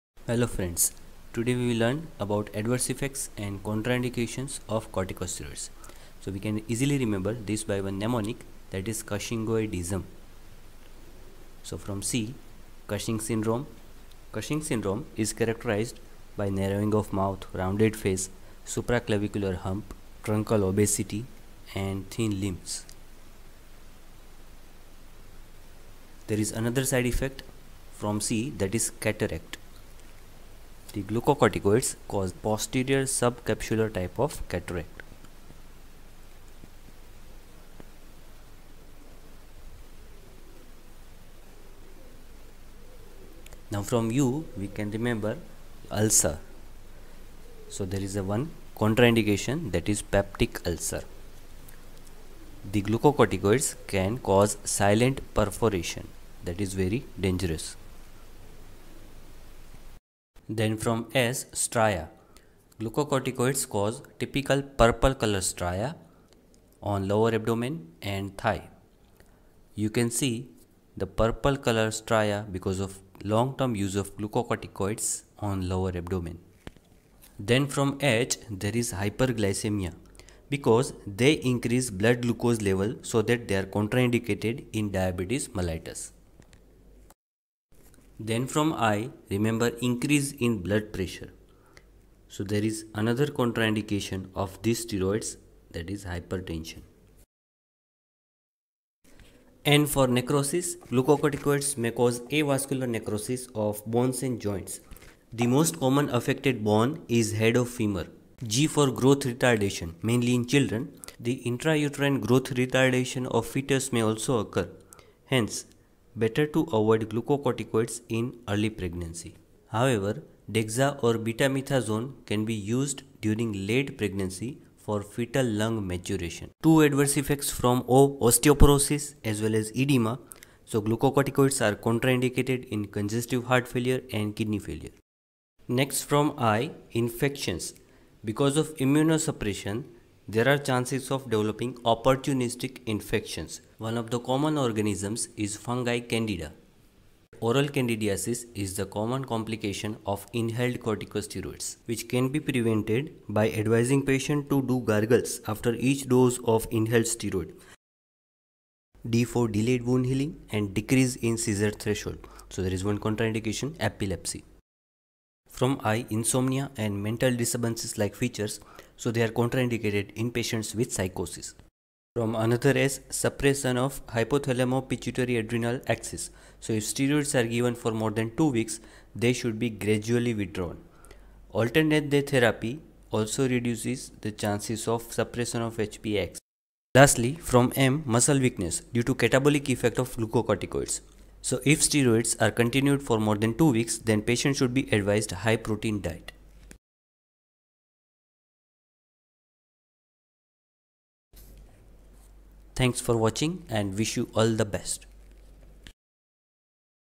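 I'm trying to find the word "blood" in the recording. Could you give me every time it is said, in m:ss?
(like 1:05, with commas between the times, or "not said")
1:21, 1:30.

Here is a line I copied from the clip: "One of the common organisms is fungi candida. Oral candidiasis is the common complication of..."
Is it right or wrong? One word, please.
right.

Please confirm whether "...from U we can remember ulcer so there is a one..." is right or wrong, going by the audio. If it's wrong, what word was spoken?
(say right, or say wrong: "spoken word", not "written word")
right.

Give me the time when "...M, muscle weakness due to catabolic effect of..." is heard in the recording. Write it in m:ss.
3:07.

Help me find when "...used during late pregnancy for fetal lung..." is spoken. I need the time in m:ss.
2:02.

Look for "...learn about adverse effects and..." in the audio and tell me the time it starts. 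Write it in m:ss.
0:01.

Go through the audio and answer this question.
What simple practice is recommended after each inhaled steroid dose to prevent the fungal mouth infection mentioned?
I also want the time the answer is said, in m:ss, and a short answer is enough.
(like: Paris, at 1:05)
Gargles, at 2:34.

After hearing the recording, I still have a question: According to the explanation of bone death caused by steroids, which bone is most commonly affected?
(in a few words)
Head of femur.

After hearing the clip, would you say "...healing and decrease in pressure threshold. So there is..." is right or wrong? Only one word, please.
wrong.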